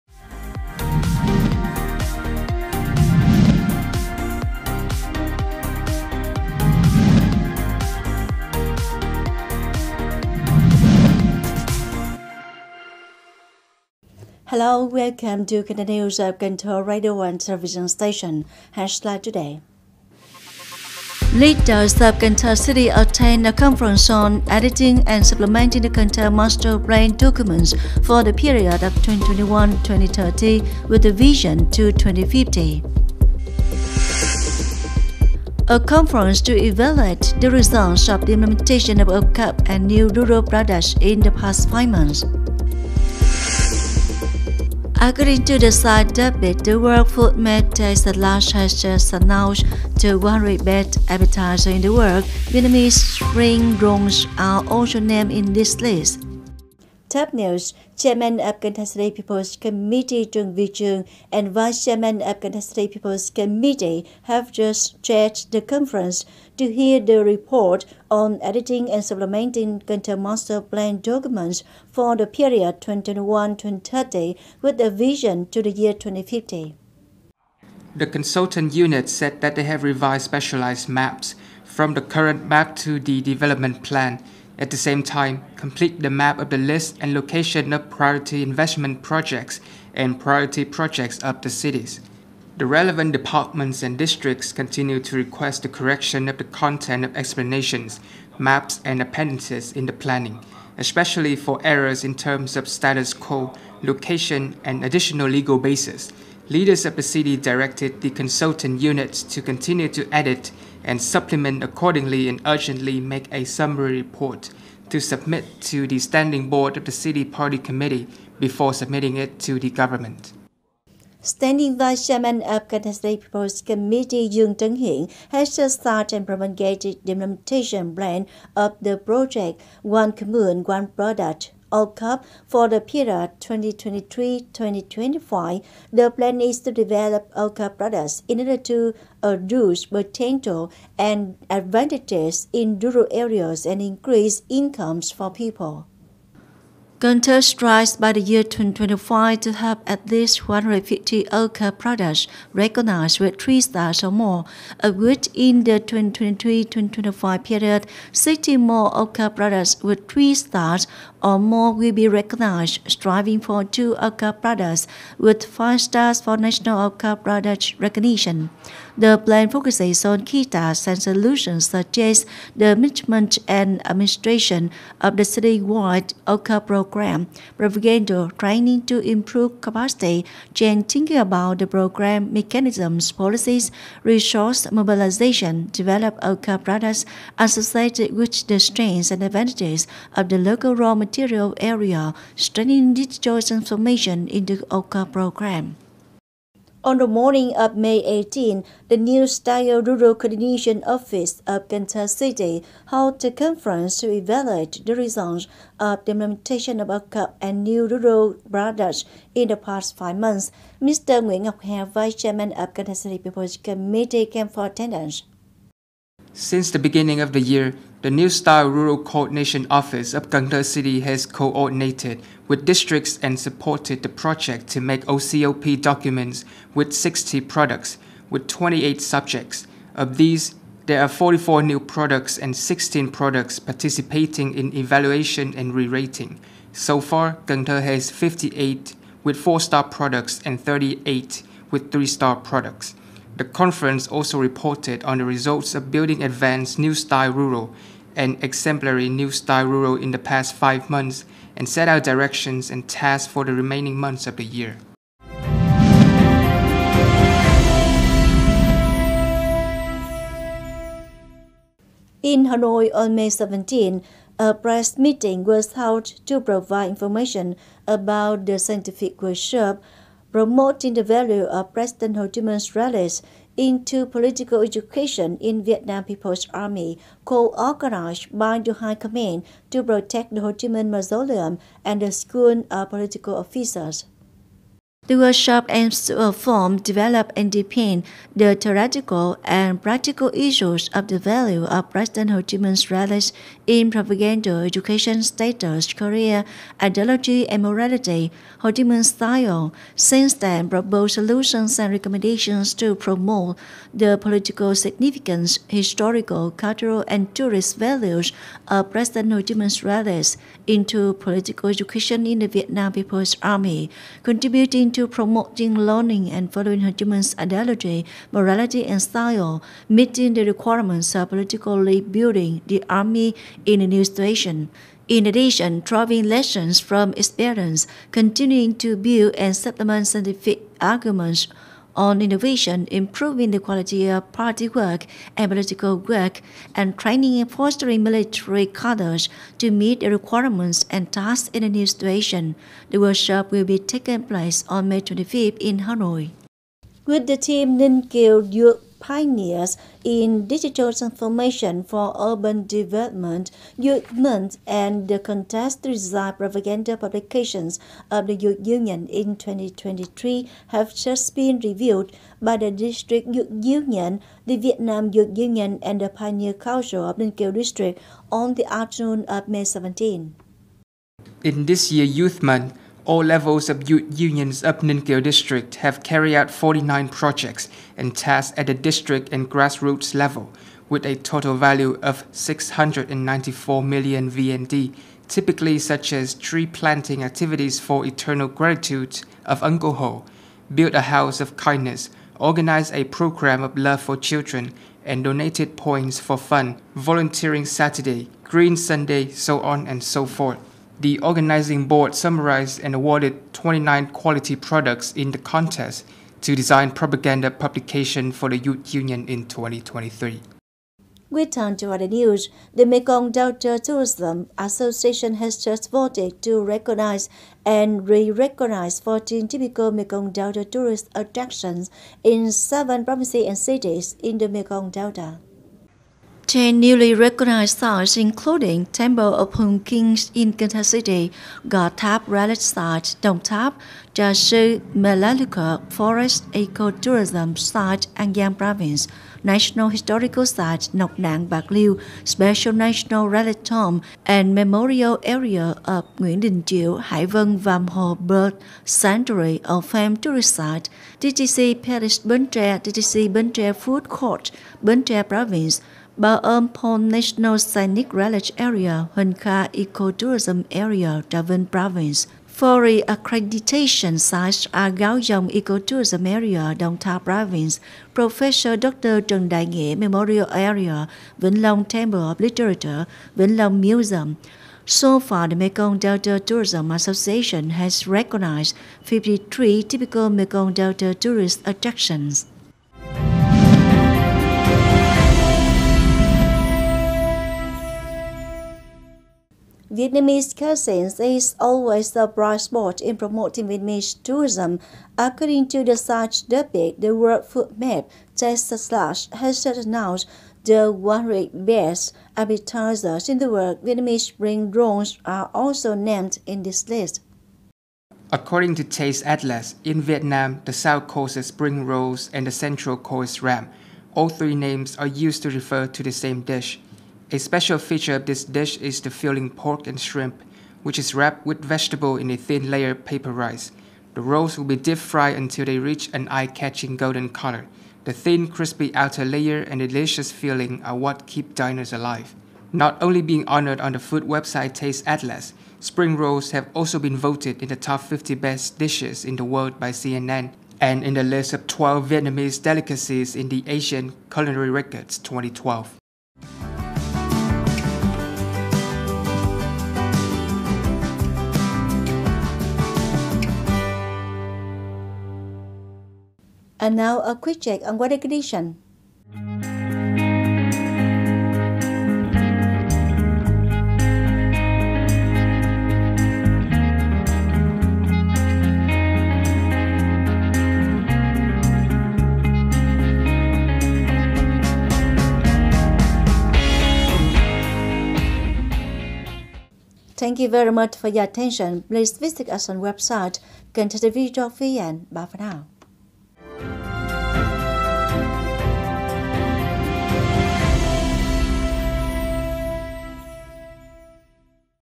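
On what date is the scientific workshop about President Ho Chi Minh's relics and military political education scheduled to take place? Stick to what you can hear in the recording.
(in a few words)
May 25.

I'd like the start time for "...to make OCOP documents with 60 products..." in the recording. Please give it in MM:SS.
03:44.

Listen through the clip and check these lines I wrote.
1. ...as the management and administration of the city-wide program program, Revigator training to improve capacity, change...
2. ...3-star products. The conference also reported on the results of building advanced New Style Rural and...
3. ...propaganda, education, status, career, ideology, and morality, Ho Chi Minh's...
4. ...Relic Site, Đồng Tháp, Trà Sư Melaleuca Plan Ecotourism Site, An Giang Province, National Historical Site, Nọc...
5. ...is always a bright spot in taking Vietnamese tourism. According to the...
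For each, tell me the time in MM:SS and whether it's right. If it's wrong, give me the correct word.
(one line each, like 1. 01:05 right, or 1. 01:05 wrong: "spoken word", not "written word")
1. 02:51 right
2. 04:01 right
3. 04:53 right
4. 07:12 wrong: "Forest", not "Plan"
5. 08:11 wrong: "promoting", not "taking".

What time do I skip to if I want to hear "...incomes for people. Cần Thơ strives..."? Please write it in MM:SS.
02:24.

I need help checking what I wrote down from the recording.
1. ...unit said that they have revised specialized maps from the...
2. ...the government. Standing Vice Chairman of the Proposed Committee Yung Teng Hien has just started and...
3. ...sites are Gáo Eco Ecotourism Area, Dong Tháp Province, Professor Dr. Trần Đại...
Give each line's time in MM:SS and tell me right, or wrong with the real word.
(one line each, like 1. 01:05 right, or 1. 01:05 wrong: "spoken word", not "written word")
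1. 01:18 right
2. 01:59 right
3. 07:44 right.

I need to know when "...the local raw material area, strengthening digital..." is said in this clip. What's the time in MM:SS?
03:10.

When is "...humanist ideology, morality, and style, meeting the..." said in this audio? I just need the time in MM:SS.
05:16.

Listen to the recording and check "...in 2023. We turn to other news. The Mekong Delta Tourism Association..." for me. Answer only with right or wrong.
right.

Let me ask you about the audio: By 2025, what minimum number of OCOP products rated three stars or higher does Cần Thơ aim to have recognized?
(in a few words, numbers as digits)
150.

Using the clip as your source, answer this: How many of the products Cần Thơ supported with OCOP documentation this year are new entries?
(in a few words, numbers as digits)
44.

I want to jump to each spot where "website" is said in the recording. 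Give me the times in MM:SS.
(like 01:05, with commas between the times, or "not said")
08:54, 09:42.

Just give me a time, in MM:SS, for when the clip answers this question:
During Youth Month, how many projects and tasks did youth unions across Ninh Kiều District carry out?
06:16.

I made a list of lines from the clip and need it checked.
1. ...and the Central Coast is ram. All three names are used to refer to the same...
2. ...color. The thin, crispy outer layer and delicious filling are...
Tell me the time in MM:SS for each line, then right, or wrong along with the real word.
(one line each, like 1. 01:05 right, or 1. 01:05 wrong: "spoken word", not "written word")
1. 08:32 right
2. 08:47 right.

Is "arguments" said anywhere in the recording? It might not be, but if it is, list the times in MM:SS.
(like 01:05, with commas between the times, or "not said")
05:30.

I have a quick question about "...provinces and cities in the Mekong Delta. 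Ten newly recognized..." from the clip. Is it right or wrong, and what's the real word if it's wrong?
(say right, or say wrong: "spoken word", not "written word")
right.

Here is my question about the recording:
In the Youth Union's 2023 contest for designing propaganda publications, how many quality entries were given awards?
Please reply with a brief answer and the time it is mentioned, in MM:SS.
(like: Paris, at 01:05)
29, at 06:43.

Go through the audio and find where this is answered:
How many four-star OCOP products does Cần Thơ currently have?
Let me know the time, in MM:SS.
03:58.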